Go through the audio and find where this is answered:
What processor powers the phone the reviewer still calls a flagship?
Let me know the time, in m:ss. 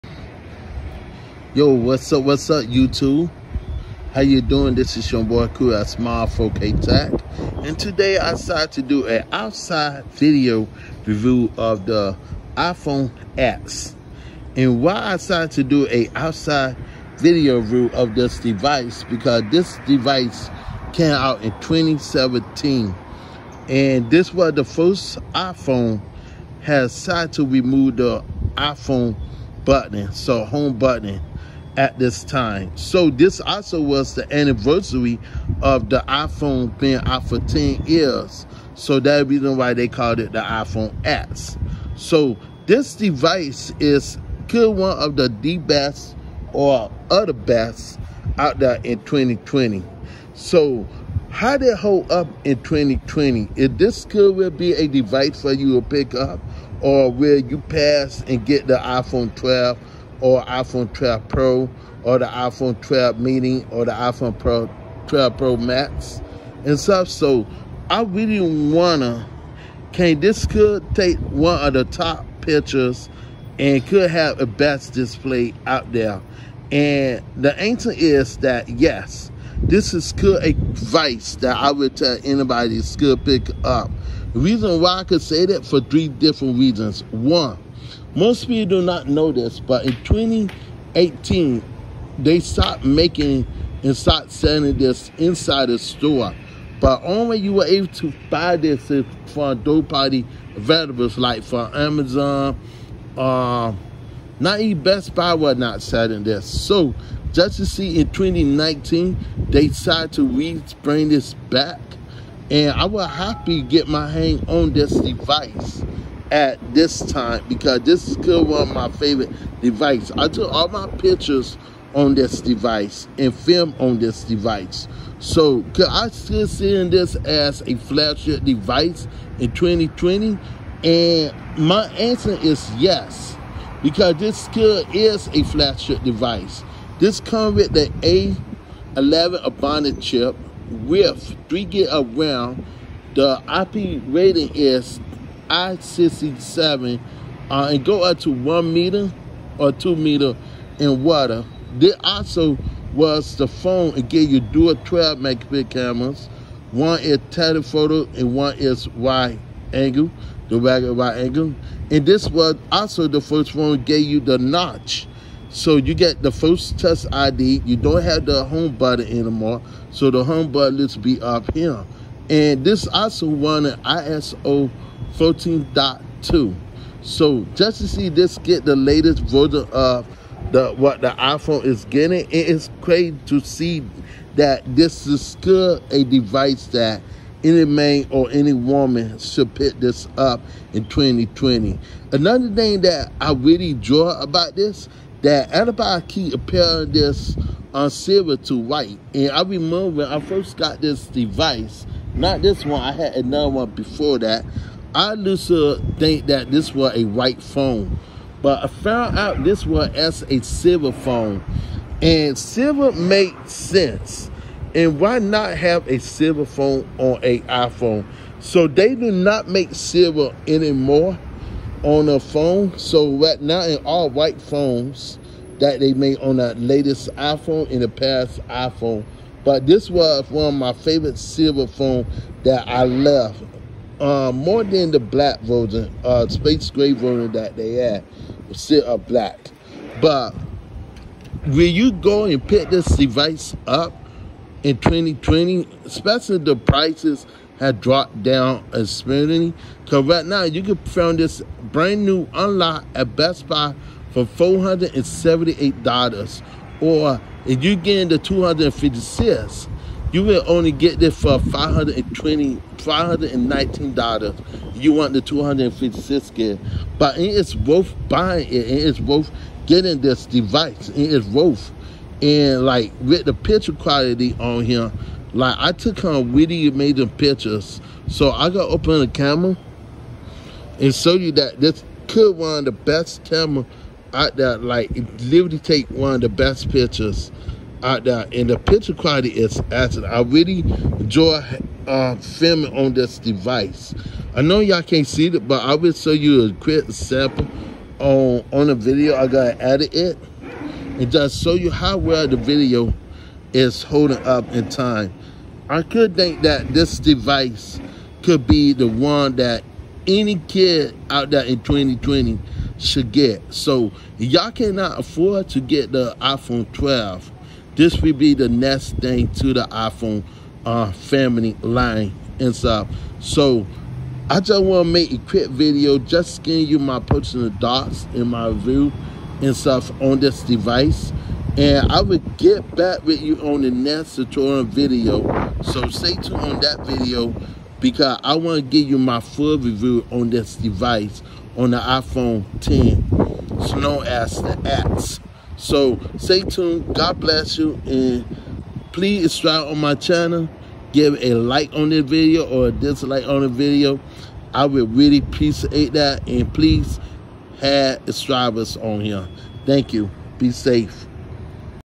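2:18.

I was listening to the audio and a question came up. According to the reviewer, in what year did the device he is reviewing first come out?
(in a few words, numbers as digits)
2017.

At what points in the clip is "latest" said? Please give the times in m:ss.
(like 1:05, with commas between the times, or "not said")
2:58, 3:46.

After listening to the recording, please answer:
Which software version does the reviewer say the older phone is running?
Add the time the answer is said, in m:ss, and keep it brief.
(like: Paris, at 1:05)
iOS 14.2, at 2:53.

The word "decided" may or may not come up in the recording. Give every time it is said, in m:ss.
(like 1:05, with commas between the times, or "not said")
0:08, 0:15, 0:26, 1:49.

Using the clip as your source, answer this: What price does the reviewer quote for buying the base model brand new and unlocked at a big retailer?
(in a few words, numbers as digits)
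$478.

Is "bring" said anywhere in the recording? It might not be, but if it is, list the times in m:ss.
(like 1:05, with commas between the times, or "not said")
1:50.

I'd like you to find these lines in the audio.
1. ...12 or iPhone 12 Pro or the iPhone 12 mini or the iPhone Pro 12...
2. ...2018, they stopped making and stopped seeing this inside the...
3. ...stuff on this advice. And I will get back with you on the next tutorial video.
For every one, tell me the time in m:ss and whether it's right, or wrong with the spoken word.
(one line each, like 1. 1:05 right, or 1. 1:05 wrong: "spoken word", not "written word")
1. 0:59 right
2. 1:30 wrong: "selling", not "seeing"
3. 5:29 wrong: "device", not "advice".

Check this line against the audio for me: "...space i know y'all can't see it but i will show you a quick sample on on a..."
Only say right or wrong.
wrong.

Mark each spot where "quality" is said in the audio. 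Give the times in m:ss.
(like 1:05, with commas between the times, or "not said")
4:33, 4:48.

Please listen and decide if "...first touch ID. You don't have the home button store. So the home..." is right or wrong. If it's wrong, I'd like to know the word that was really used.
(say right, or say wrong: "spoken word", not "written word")
wrong: "anymore", not "store".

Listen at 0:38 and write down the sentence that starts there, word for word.
So that reason why they called it the iPhone X.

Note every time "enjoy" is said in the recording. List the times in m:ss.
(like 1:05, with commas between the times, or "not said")
3:13, 4:50.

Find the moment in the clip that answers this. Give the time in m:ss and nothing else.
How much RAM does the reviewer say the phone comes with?
2:21.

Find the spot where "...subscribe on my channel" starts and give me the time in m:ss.
5:49.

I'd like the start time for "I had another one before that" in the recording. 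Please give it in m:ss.
3:22.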